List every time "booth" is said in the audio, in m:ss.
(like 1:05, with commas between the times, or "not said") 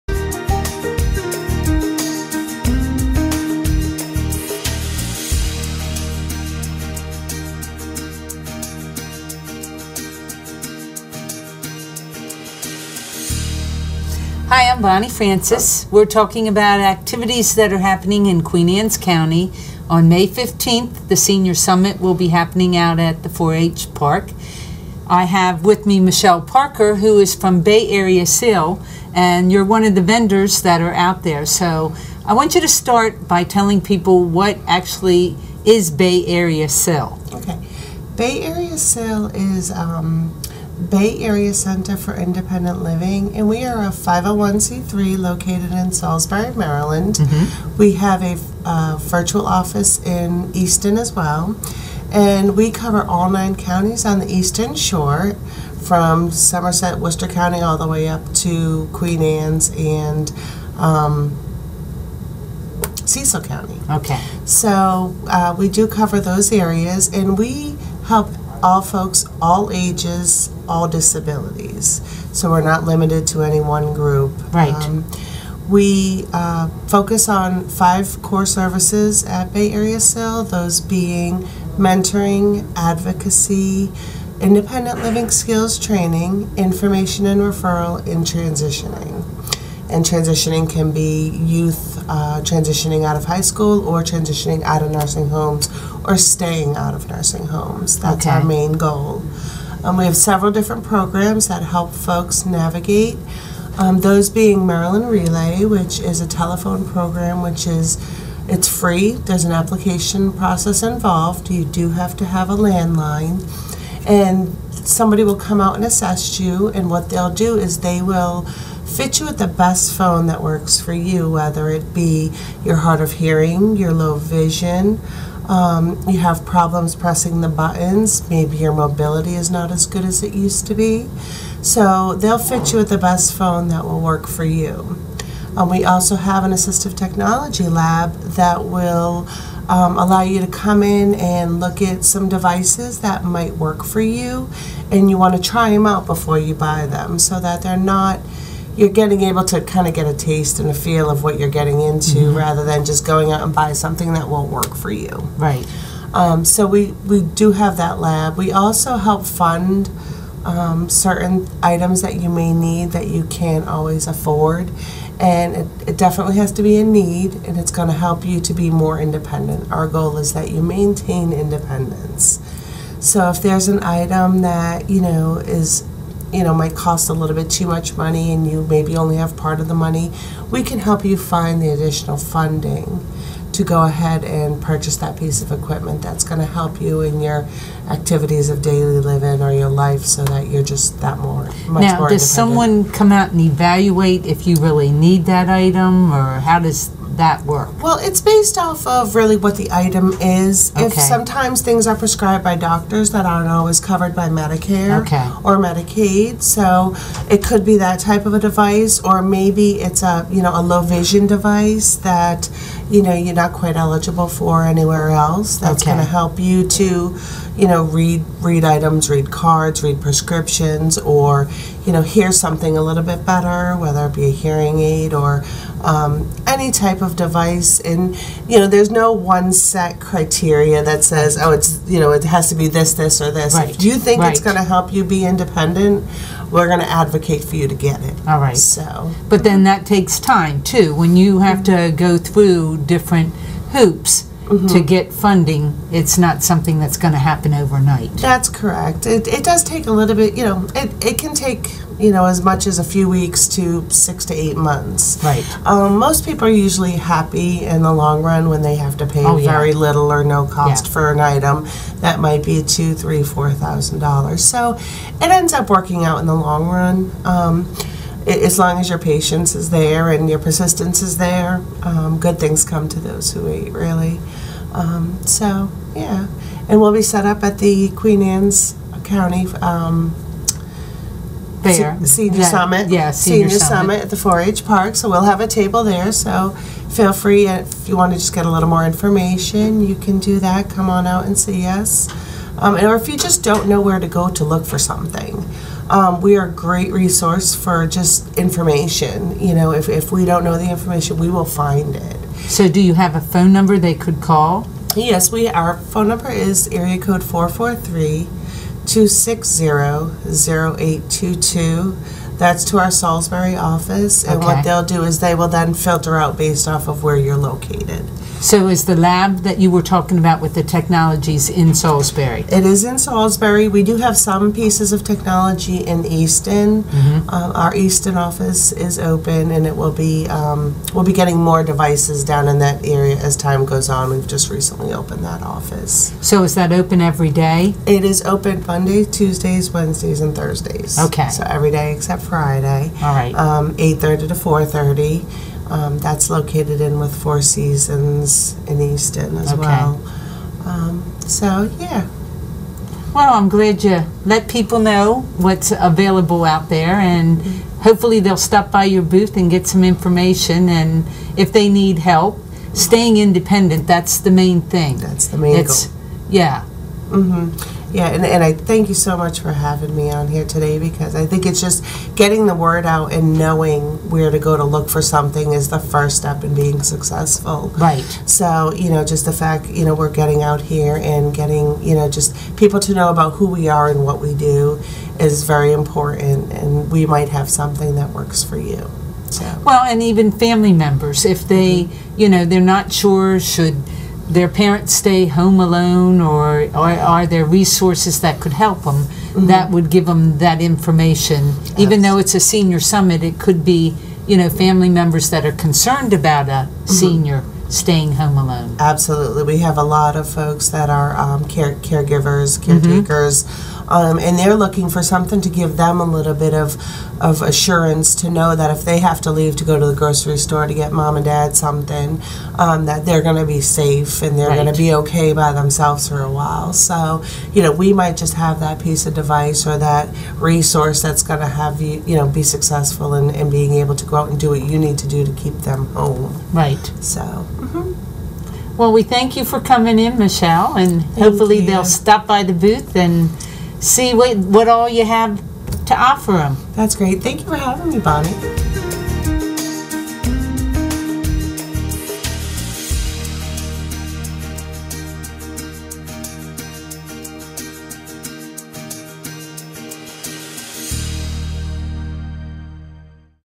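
5:59, 7:22.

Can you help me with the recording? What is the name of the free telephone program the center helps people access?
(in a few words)
Maryland Relay.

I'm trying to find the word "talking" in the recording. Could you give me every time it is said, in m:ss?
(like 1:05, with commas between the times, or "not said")
0:16, 5:19.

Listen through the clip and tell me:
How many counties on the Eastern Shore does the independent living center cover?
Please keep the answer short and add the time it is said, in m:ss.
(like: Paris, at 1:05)
9, at 0:53.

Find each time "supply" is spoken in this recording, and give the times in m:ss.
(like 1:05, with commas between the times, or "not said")
not said.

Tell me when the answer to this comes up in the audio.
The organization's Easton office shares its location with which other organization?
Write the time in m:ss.
5:47.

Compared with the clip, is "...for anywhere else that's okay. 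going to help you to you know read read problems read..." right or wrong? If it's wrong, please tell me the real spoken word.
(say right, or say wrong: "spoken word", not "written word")
wrong: "items", not "problems".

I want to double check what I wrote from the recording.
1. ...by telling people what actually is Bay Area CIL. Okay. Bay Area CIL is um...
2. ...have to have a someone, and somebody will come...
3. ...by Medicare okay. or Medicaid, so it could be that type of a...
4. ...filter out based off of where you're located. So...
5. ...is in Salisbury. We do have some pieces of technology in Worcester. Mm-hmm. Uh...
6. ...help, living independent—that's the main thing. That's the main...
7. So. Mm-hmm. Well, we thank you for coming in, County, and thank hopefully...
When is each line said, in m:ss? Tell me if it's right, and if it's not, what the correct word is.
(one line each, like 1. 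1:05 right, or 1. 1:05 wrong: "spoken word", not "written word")
1. 0:33 right
2. 1:51 wrong: "landline", not "someone"
3. 3:24 right
4. 5:15 right
5. 5:22 wrong: "Easton", not "Worcester"
6. 6:01 wrong: "staying", not "living"
7. 7:17 wrong: "Michelle", not "County".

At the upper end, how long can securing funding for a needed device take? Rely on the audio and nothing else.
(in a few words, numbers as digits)
6 to 8 months.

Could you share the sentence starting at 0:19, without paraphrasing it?
On May 15th, the Senior Summit will be happening out at the 4 H Park.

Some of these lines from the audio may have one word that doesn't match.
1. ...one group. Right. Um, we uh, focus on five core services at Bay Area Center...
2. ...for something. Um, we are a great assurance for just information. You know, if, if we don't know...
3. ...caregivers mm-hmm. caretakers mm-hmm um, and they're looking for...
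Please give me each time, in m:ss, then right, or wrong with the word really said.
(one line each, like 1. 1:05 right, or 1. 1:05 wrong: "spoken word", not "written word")
1. 1:13 wrong: "CIL", not "Center"
2. 4:54 wrong: "resource", not "assurance"
3. 6:51 right.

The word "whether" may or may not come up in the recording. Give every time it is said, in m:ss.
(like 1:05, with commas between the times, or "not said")
2:01, 3:43.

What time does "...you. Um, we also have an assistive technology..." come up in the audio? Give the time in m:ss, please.
2:14.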